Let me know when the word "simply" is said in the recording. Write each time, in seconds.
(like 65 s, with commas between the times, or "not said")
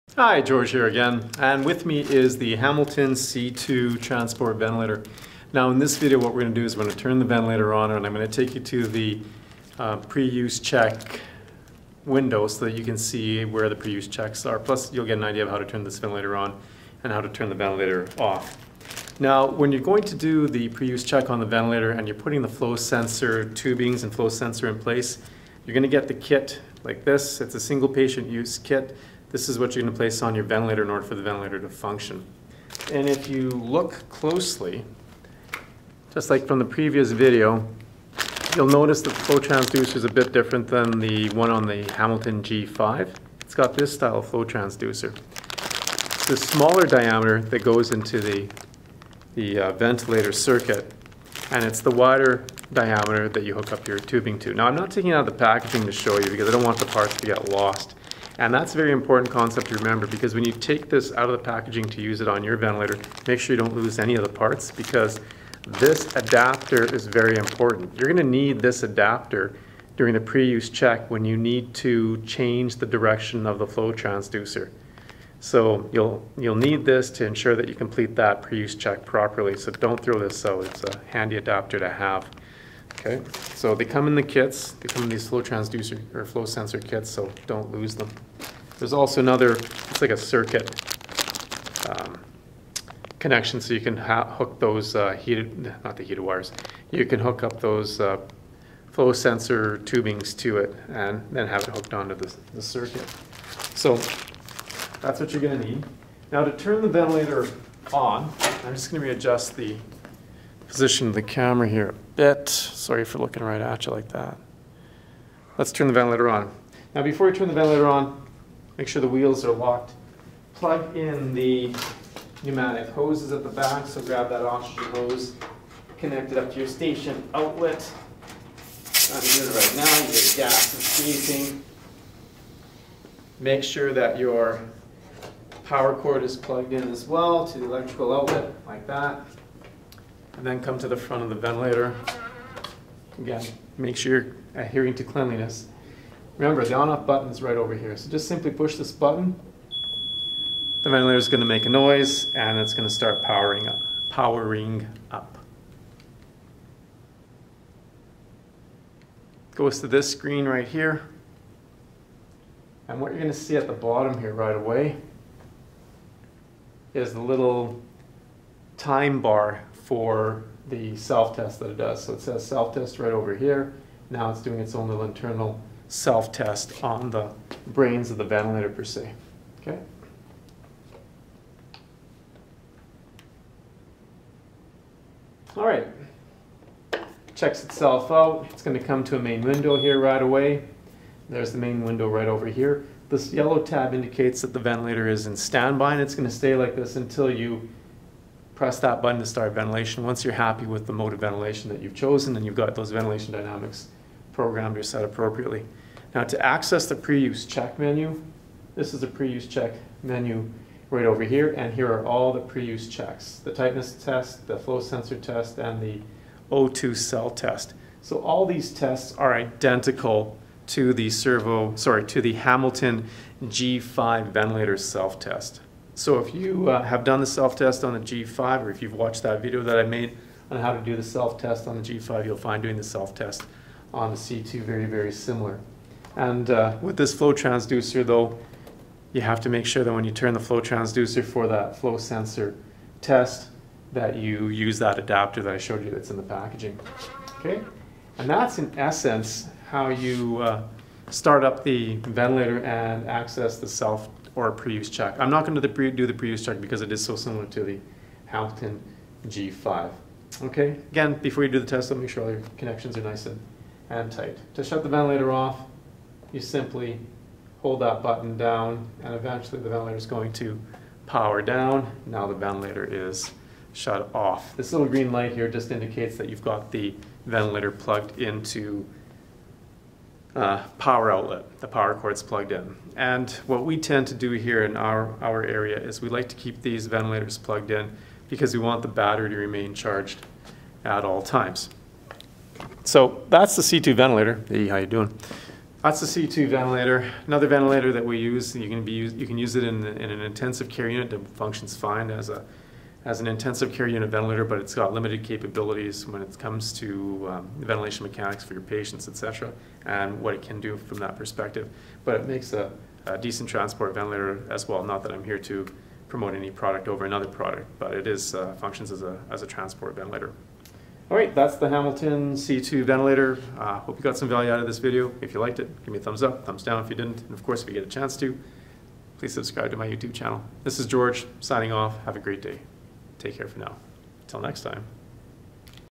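148 s, 266 s.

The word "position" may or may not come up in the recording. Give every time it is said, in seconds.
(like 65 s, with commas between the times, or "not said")
110 s.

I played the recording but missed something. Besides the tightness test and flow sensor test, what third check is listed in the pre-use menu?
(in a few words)
O2 cell test.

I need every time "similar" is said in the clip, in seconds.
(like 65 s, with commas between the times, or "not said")
235 s, 257 s.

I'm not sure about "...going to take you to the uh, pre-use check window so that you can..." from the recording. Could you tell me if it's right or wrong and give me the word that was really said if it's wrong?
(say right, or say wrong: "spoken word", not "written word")
right.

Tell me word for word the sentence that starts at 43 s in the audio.
It's got this style of flow transducer.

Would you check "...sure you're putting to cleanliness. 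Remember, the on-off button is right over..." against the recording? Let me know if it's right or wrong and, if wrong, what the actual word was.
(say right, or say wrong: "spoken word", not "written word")
wrong: "adhering", not "putting".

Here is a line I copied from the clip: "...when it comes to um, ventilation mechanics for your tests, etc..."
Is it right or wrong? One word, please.
wrong.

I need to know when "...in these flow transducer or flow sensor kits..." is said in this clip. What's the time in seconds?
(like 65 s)
85 s.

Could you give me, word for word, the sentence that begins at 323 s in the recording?
Uh, hope you got some value out of this video.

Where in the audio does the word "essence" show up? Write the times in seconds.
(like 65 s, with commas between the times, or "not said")
248 s.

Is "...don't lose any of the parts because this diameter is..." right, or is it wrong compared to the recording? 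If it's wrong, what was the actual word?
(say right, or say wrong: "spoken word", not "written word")
wrong: "adapter", not "diameter".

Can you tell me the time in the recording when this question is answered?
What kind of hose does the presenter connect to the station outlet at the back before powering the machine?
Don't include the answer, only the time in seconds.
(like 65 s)
124 s.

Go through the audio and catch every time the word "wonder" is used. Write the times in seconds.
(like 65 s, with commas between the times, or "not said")
not said.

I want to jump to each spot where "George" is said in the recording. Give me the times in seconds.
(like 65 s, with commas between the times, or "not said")
0 s, 330 s.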